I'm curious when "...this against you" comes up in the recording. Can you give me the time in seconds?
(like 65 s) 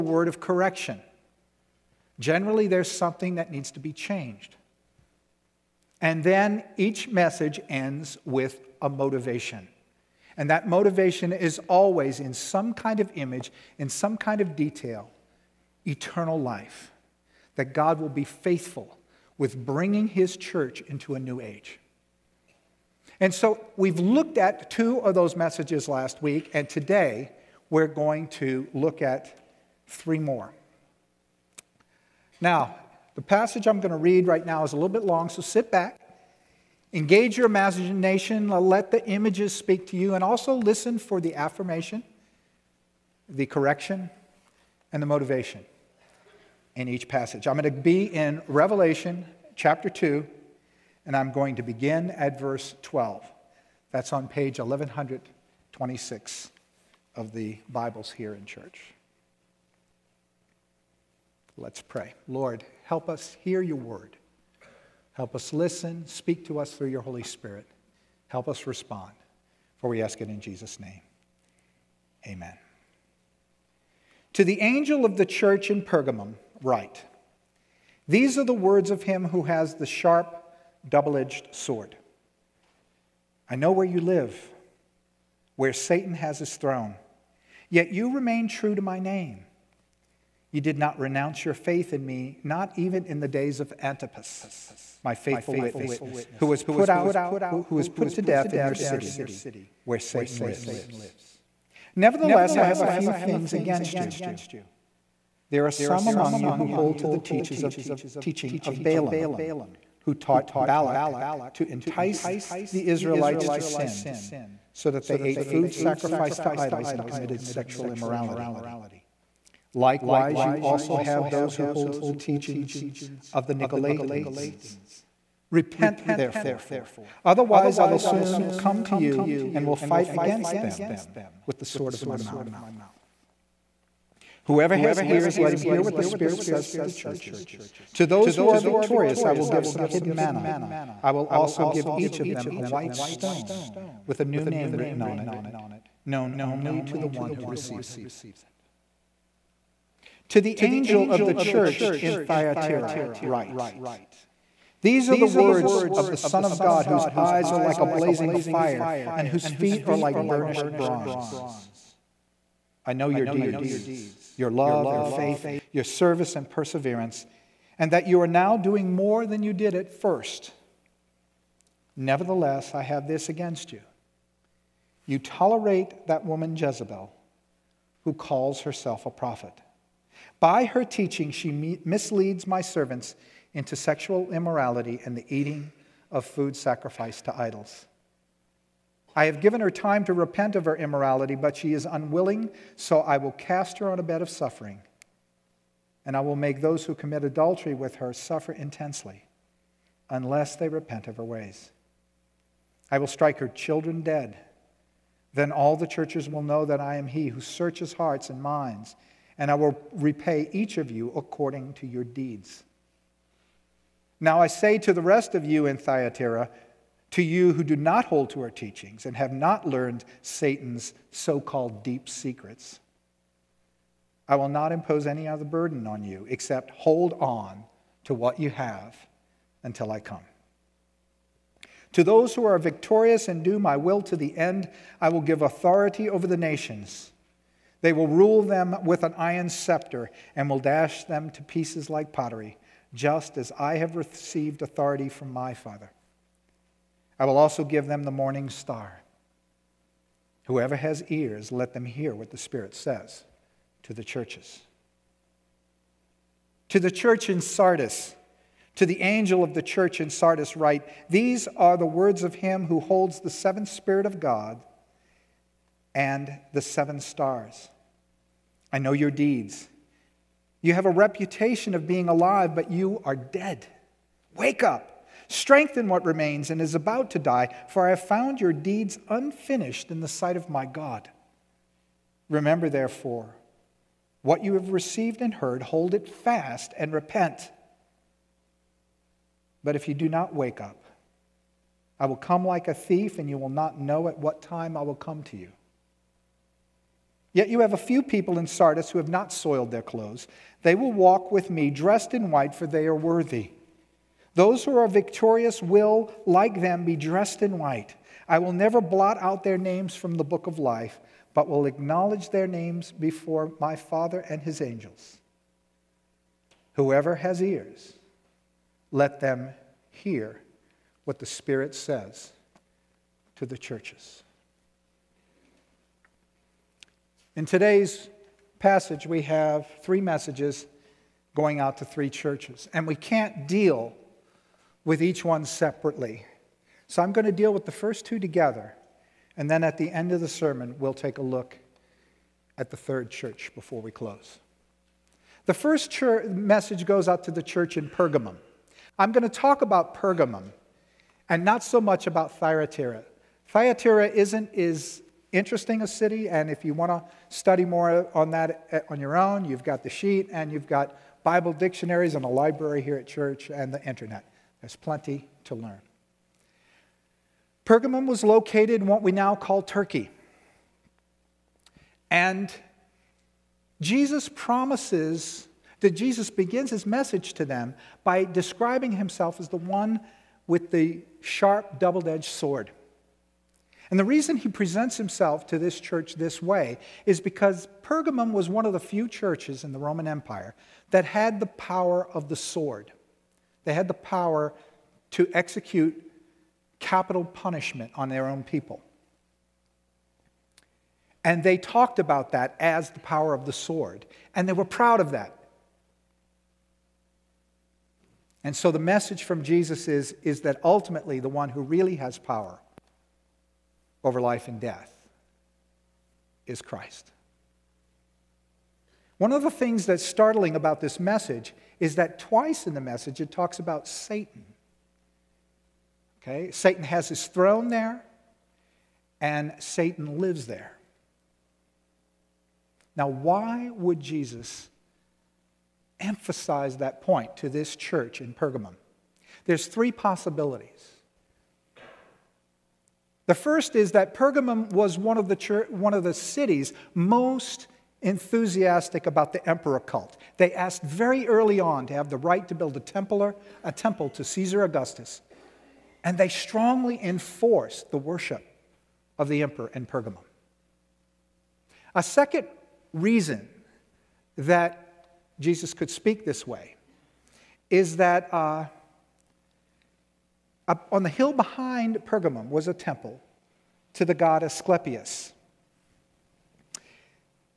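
173 s.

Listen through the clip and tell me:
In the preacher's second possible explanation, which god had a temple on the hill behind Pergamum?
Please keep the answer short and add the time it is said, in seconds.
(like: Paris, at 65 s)
Asclepius, at 474 s.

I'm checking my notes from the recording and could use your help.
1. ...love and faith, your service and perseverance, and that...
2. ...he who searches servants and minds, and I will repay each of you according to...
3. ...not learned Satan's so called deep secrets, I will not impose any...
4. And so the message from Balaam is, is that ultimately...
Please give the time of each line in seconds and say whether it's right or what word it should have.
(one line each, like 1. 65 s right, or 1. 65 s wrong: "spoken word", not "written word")
1. 164 s right
2. 207 s wrong: "hearts", not "servants"
3. 219 s right
4. 408 s wrong: "Jesus", not "Balaam".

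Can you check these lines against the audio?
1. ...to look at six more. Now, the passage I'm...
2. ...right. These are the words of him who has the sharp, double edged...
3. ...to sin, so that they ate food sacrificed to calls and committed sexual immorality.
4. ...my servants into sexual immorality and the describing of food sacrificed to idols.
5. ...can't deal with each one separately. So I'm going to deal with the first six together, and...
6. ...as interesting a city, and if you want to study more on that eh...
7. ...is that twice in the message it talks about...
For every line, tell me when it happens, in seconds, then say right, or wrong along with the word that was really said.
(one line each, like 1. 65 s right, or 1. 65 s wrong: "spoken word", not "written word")
1. 28 s wrong: "three", not "six"
2. 76 s right
3. 113 s wrong: "idols", not "calls"
4. 182 s wrong: "eating", not "describing"
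5. 332 s wrong: "two", not "six"
6. 354 s right
7. 421 s right.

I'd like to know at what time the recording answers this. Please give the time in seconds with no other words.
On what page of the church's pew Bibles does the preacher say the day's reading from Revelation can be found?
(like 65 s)
54 s.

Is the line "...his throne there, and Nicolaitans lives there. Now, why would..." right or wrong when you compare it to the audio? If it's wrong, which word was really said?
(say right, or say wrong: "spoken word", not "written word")
wrong: "Satan", not "Nicolaitans".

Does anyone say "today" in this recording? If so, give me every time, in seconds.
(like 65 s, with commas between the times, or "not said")
26 s, 327 s.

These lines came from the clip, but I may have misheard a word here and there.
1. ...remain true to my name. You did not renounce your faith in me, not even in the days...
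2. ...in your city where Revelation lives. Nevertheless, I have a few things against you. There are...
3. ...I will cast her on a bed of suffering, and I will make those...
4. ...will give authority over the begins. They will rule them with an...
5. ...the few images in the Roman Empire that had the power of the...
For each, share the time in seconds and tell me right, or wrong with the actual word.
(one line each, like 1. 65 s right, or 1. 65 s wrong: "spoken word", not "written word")
1. 88 s right
2. 98 s wrong: "Satan", not "Revelation"
3. 193 s right
4. 235 s wrong: "nations", not "begins"
5. 388 s wrong: "churches", not "images".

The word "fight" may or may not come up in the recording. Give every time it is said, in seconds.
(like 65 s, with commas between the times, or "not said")
129 s.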